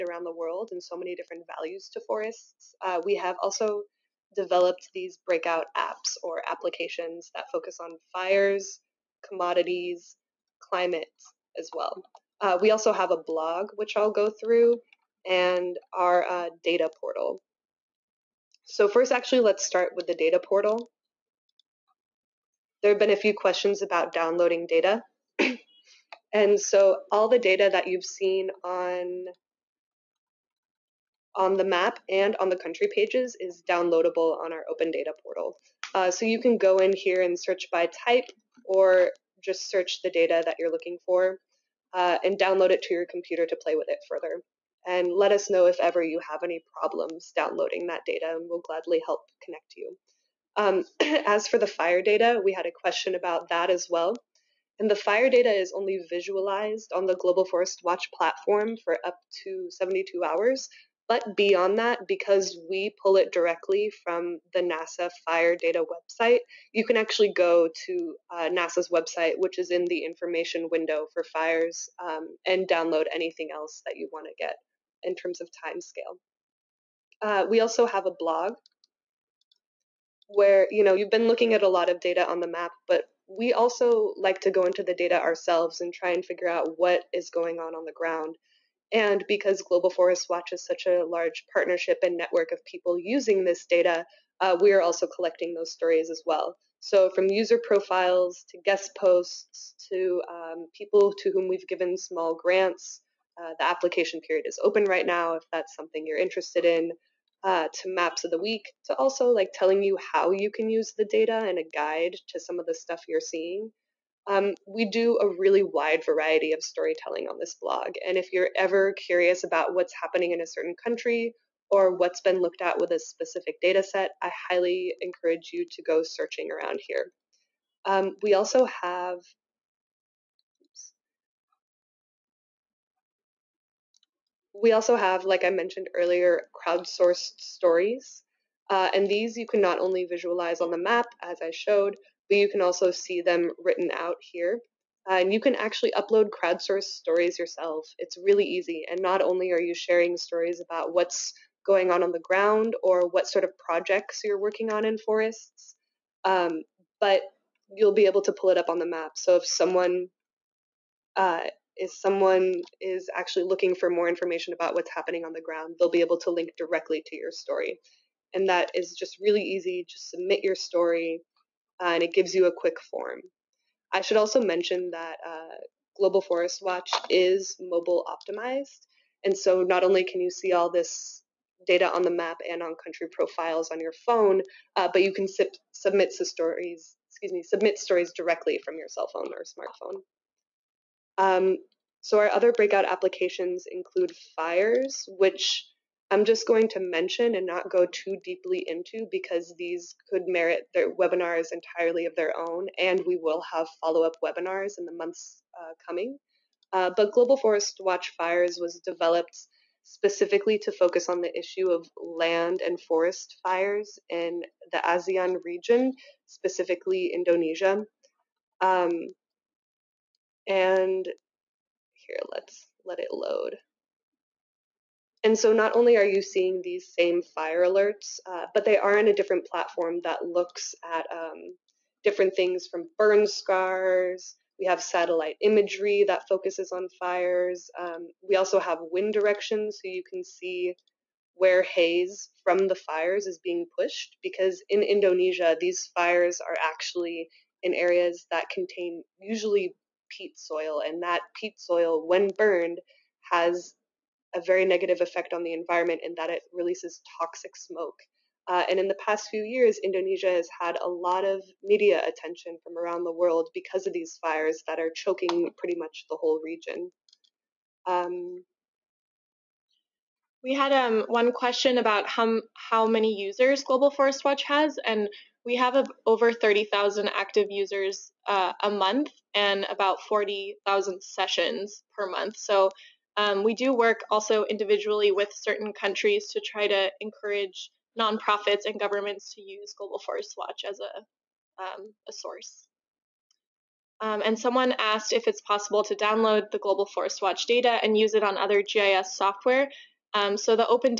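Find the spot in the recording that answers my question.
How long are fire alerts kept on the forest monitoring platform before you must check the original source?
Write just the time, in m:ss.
0:59.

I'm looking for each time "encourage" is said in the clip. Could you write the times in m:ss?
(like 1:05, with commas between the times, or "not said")
2:05, 4:46.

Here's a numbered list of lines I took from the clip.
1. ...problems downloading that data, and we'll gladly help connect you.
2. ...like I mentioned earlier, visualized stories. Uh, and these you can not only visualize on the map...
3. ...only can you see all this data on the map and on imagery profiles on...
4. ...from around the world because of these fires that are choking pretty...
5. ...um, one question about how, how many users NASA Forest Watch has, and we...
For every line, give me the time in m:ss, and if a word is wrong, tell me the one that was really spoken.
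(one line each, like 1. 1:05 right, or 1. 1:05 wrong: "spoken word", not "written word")
1. 0:46 right
2. 2:15 wrong: "crowdsourced", not "visualized"
3. 2:59 wrong: "country", not "imagery"
4. 4:22 right
5. 4:30 wrong: "Global", not "NASA".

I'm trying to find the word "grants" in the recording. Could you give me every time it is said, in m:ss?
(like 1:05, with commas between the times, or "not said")
1:42.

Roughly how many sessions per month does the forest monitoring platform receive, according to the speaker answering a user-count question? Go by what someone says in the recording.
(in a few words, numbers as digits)
40,000.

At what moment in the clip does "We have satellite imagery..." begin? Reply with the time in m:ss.
3:54.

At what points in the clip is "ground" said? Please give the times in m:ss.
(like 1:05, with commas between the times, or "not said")
1:27, 2:32, 2:45.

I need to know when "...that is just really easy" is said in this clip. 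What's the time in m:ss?
2:48.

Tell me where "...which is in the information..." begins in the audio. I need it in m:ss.
1:09.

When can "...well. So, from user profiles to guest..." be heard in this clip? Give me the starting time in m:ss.
1:36.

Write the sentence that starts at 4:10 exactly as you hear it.
And that peat soil, when burned, has a very negative effect on the environment in that it releases toxic smoke.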